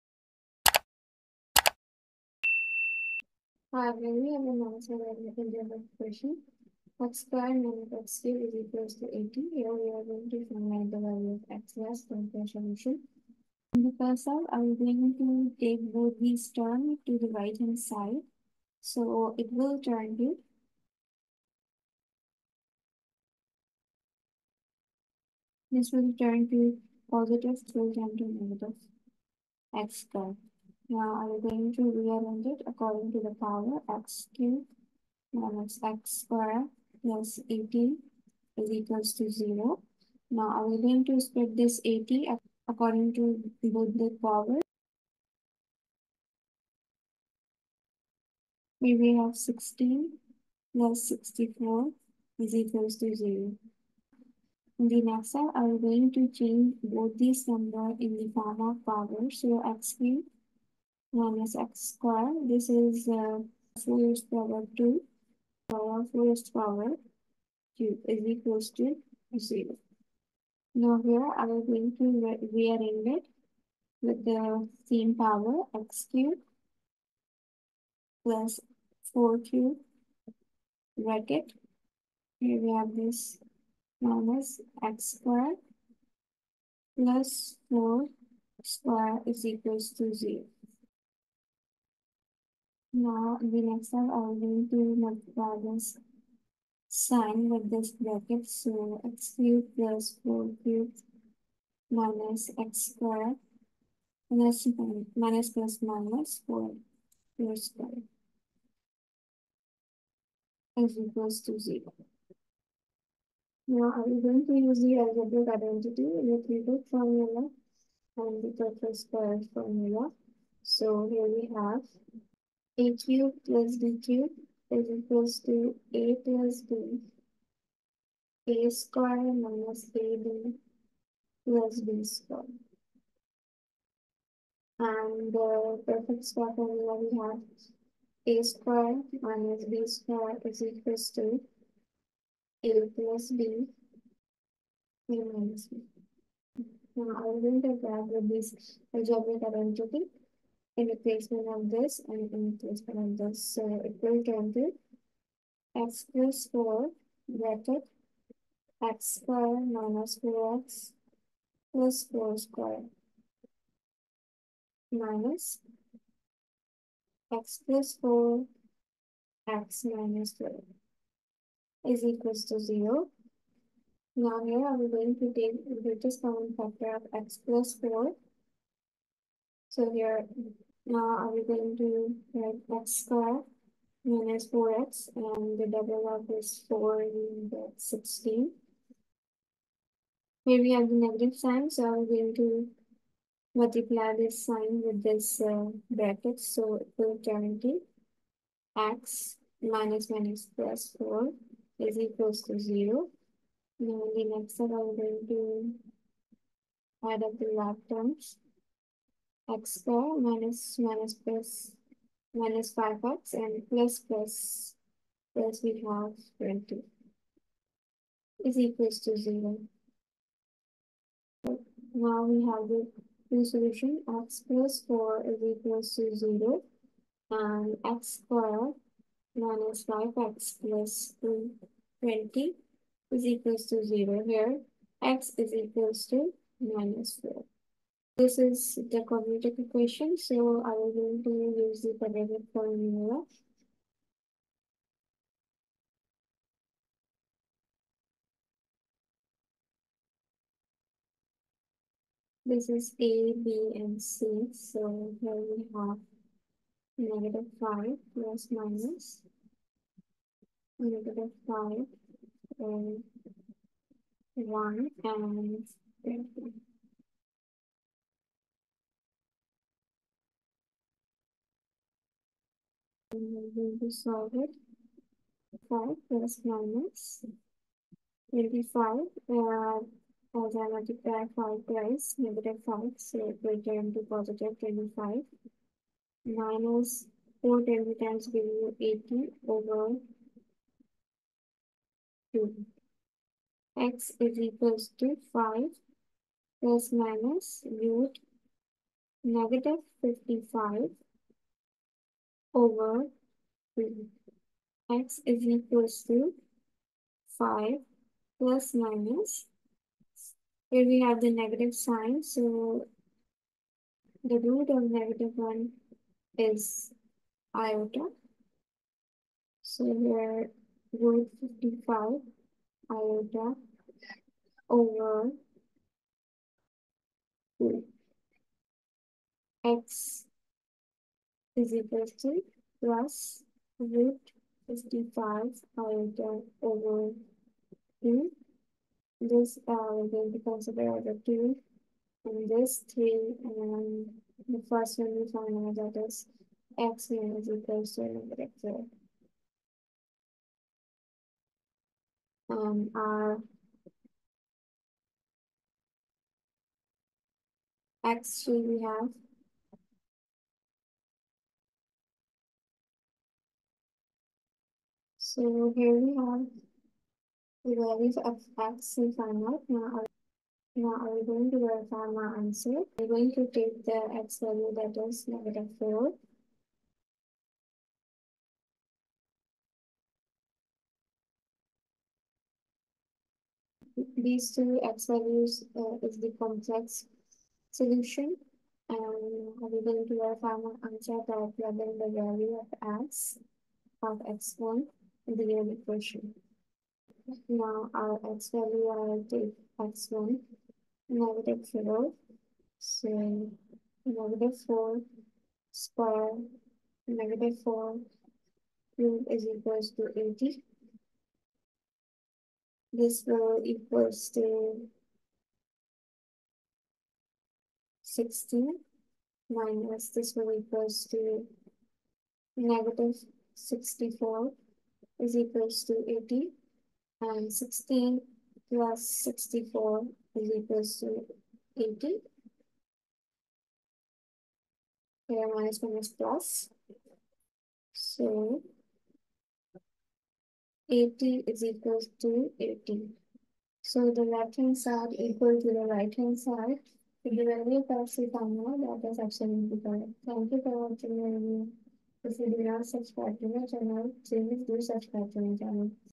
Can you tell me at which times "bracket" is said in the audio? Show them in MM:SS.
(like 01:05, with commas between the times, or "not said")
01:20, 01:37, 02:37, 03:15.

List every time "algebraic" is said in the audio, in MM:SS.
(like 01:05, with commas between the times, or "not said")
01:54, 02:28.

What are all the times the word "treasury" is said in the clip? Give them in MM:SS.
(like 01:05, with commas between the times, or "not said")
not said.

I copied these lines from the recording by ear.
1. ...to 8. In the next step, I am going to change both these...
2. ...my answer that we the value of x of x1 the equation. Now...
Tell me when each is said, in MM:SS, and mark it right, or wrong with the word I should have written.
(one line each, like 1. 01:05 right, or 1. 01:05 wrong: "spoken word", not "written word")
1. 00:52 wrong: "0", not "8"
2. 06:30 right.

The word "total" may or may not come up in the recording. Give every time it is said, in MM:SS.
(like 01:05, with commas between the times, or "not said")
01:58.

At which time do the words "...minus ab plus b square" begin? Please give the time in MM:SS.
02:09.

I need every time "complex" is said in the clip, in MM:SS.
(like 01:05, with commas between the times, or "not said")
06:26.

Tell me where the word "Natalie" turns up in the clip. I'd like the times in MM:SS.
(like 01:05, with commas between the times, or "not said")
not said.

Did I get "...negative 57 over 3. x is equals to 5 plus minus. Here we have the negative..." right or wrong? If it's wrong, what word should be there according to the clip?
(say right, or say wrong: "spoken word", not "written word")
wrong: "55", not "57".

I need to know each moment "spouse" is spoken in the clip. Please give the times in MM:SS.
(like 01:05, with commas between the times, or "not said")
not said.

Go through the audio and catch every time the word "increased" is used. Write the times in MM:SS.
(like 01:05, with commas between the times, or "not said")
not said.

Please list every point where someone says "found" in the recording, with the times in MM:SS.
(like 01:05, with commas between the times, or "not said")
05:45.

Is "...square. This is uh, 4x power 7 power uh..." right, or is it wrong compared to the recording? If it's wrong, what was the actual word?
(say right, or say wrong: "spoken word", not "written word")
wrong: "2", not "7".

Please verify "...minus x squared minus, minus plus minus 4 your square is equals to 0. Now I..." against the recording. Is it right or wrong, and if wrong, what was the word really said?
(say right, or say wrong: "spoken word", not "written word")
right.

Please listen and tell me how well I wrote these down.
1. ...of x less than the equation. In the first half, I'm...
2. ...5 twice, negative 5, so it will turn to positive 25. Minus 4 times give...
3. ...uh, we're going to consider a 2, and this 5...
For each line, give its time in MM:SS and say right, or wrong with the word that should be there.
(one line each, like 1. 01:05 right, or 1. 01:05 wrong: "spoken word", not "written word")
1. 00:11 wrong: "solution", not "equation"
2. 04:41 right
3. 05:39 wrong: "3", not "5".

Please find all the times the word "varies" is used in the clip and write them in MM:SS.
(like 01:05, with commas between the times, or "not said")
not said.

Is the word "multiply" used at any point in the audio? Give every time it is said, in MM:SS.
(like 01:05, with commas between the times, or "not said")
01:34, 03:13, 04:40.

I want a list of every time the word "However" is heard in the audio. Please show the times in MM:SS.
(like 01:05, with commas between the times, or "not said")
00:03.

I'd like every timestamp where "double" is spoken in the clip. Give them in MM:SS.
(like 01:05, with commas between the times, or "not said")
03:05.